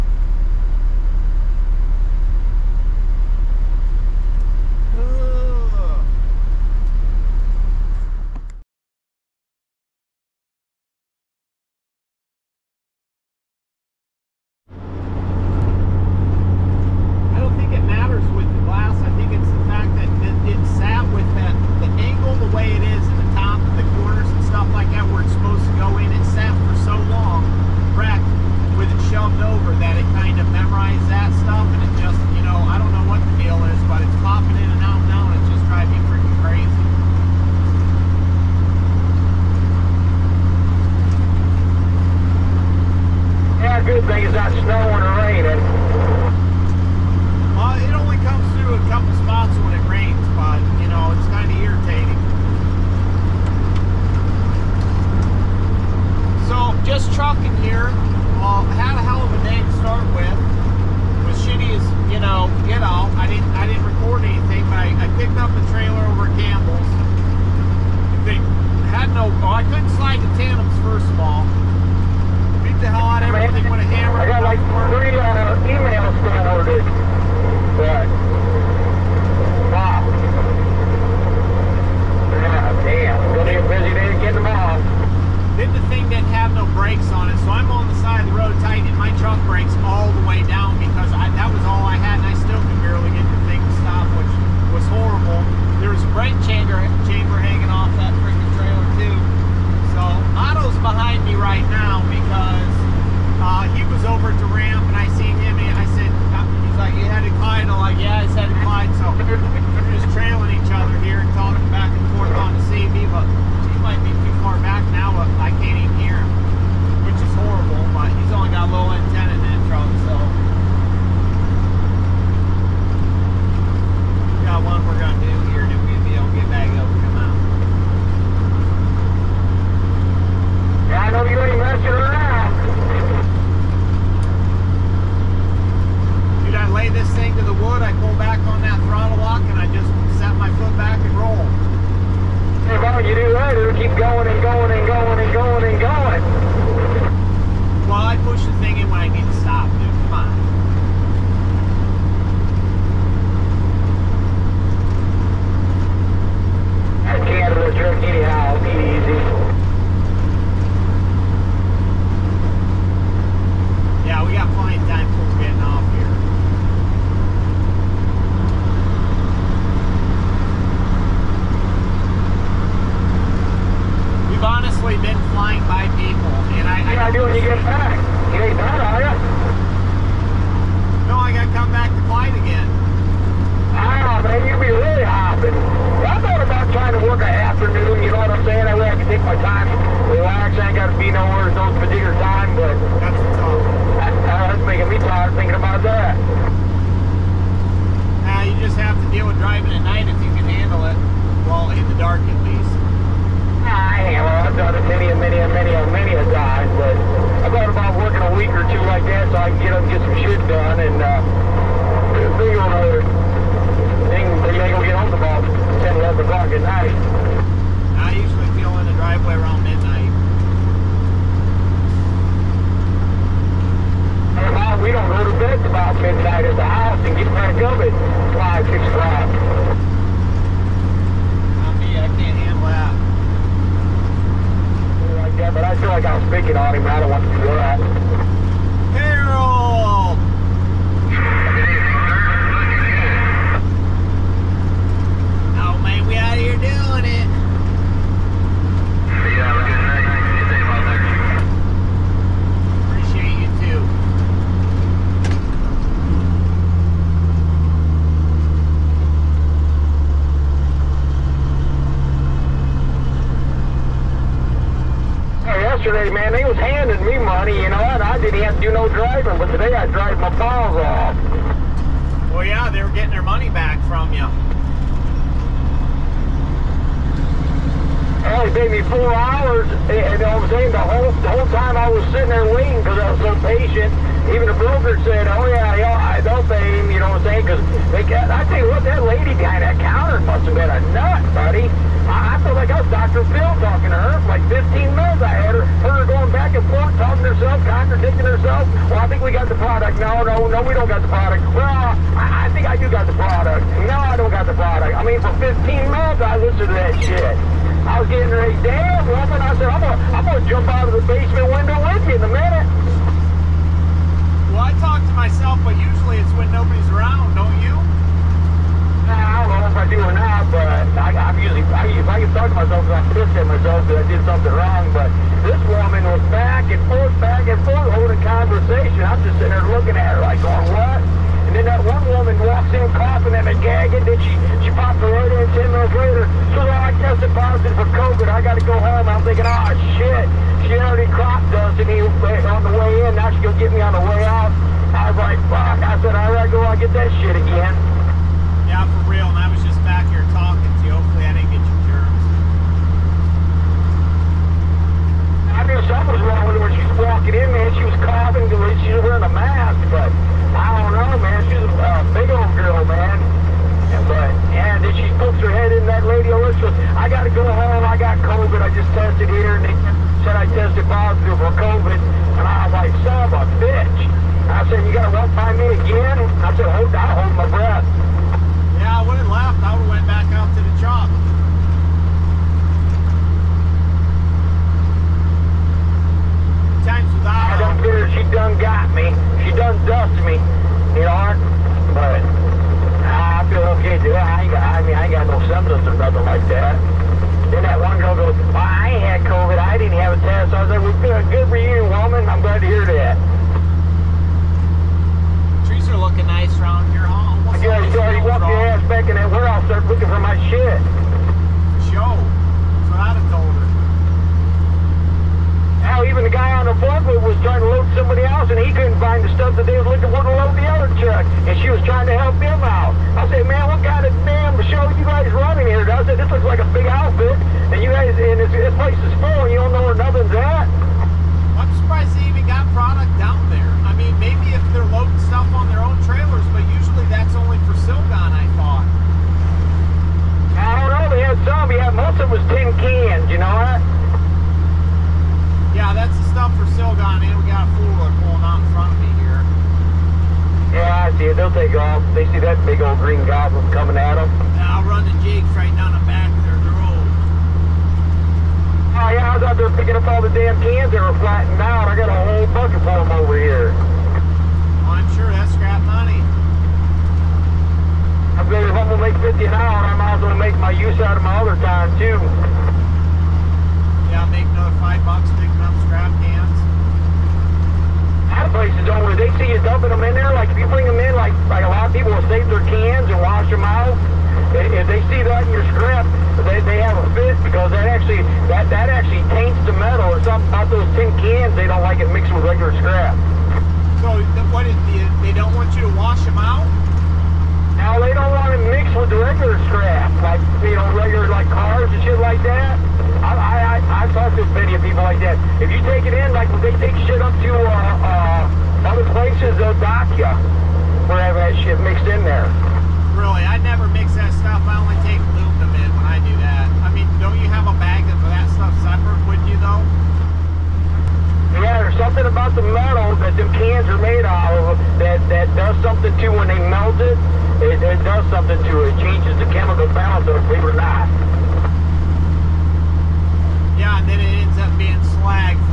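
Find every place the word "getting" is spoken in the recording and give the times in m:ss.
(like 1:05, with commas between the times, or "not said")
4:32, 5:08.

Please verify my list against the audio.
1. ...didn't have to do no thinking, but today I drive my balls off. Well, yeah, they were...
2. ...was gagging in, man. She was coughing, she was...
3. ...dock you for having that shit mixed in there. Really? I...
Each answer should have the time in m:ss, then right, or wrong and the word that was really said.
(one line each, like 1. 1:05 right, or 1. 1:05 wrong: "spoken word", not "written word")
1. 4:28 wrong: "driving", not "thinking"
2. 5:56 wrong: "walking", not "gagging"
3. 8:29 right.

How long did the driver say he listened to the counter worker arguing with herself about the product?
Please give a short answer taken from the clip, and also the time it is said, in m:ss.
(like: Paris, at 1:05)
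15 minutes, at 5:05.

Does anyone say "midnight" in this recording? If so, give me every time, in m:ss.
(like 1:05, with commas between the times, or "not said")
3:39, 3:45.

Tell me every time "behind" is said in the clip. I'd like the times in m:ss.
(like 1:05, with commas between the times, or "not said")
1:40, 4:49.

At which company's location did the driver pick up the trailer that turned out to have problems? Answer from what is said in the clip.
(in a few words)
Campbell's.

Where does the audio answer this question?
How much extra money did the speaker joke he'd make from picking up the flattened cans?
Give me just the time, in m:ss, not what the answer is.
7:54.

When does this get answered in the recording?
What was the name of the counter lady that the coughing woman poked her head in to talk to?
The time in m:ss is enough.
6:06.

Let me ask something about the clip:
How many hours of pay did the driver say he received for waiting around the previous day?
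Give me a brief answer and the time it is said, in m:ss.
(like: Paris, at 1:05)
4 hours, at 4:38.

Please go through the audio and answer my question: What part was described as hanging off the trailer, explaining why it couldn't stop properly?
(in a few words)
brake chamber.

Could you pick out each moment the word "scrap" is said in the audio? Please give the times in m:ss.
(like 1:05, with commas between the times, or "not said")
7:45, 7:55, 8:05, 8:12, 8:19.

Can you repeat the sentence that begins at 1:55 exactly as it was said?
I can't even hear him, which is horrible, but he's only got low antenna in that truck, so.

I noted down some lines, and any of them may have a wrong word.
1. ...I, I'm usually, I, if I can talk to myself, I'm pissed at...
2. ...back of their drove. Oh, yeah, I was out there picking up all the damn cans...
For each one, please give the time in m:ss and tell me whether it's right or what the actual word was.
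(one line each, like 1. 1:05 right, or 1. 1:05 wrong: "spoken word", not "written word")
1. 5:20 right
2. 7:36 right.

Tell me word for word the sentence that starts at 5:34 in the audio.
Then she, she pops her right in 10 minutes later.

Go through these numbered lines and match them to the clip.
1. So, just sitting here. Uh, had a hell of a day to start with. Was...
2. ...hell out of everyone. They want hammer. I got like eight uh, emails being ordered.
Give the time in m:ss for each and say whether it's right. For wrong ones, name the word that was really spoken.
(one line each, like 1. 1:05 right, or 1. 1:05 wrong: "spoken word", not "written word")
1. 0:56 wrong: "trucking", not "sitting"
2. 1:12 wrong: "three", not "eight".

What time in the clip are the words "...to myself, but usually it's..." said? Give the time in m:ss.
5:15.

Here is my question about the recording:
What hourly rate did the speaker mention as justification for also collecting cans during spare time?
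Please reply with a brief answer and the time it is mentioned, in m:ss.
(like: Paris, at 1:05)
$50 an hour, at 7:49.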